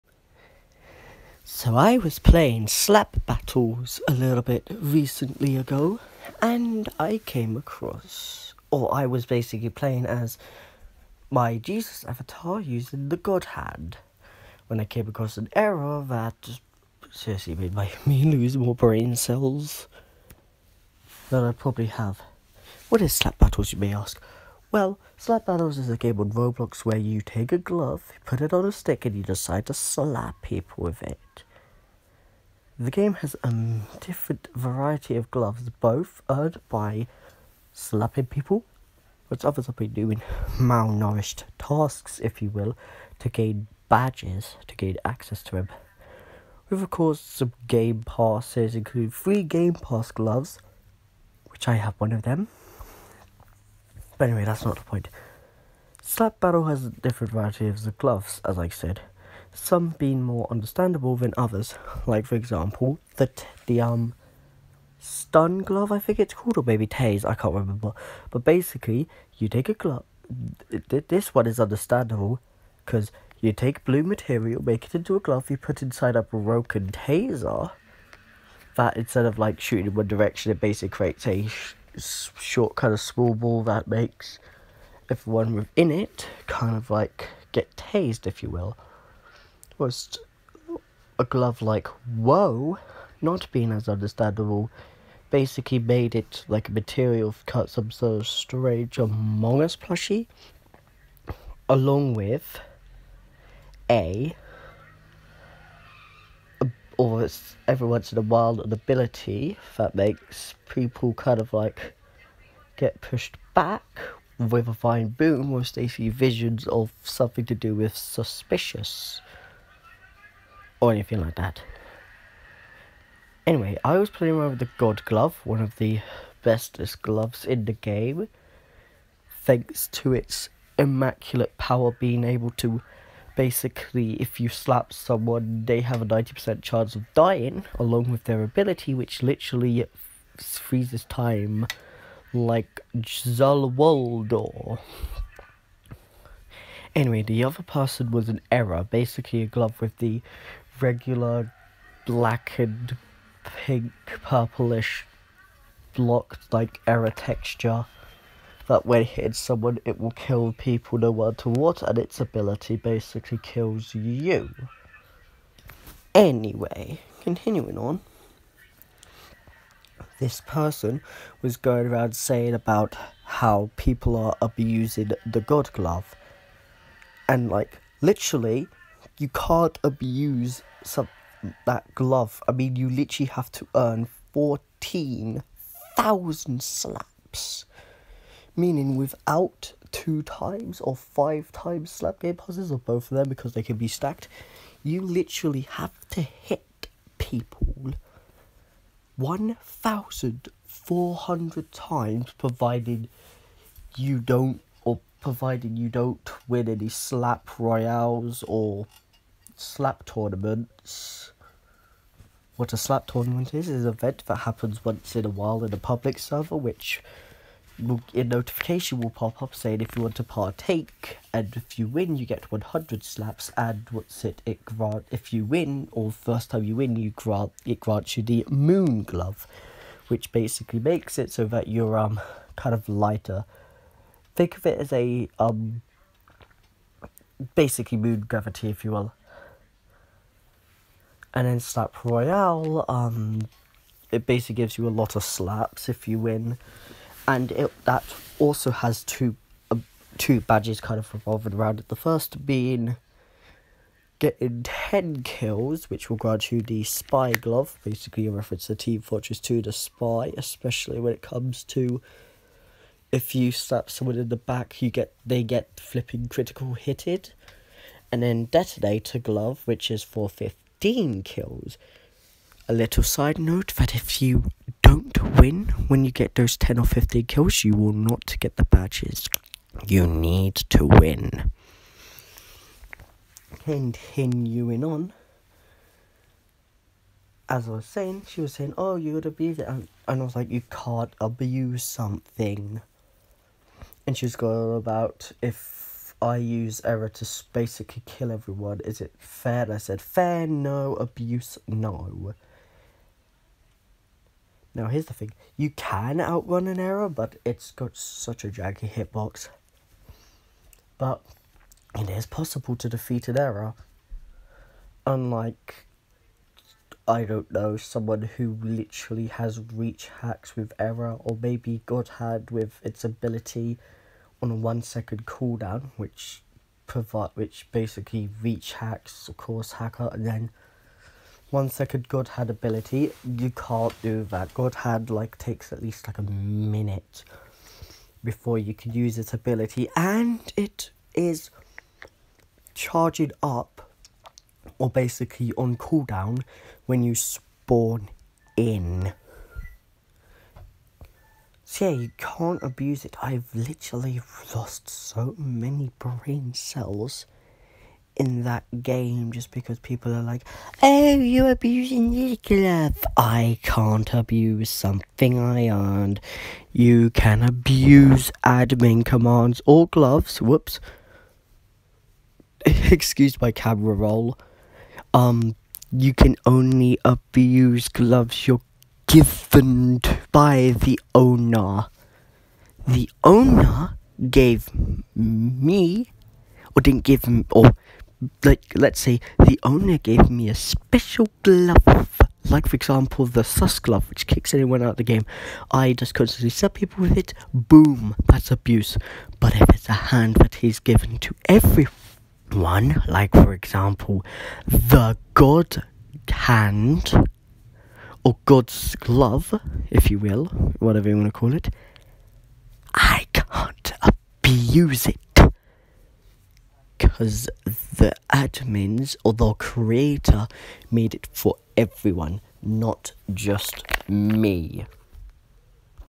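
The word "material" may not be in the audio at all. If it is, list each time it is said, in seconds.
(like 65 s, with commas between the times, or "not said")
74 s, 96 s.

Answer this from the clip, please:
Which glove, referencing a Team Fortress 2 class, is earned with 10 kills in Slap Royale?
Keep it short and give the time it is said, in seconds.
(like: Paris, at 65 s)
Spy Glove, at 256 s.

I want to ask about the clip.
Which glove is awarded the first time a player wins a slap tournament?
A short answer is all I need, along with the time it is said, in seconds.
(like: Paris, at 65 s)
Moon Glove, at 228 s.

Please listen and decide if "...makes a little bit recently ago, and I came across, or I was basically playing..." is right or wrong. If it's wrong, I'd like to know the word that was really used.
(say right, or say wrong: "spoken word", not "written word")
wrong: "battles", not "makes".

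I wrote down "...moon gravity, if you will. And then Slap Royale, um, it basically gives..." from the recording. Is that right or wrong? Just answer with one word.
right.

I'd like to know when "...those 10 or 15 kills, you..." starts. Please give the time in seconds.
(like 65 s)
276 s.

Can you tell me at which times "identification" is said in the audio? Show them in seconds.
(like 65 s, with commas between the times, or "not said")
not said.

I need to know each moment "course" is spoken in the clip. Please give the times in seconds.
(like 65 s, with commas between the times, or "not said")
46 s, 329 s.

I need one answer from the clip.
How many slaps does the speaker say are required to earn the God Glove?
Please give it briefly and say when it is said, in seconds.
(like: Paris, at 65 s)
14,000, at 184 s.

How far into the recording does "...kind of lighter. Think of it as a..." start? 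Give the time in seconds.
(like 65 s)
232 s.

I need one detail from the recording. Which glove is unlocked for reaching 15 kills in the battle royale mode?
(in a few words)
Detonator Glove.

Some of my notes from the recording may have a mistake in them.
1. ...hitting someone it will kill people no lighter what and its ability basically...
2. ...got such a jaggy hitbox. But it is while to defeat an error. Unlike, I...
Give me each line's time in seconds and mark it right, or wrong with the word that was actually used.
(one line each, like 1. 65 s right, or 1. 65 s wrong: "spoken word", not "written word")
1. 159 s wrong: "matter", not "lighter"
2. 307 s wrong: "possible", not "while".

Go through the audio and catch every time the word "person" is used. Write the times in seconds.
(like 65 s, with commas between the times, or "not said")
147 s, 170 s.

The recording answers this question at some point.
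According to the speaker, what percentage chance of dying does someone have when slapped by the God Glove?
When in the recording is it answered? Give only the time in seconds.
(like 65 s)
136 s.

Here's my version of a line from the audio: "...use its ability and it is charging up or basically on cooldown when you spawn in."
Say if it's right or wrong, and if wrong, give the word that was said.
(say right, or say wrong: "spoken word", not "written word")
right.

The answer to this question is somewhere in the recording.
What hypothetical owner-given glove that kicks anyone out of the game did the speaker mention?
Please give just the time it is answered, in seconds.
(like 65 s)
393 s.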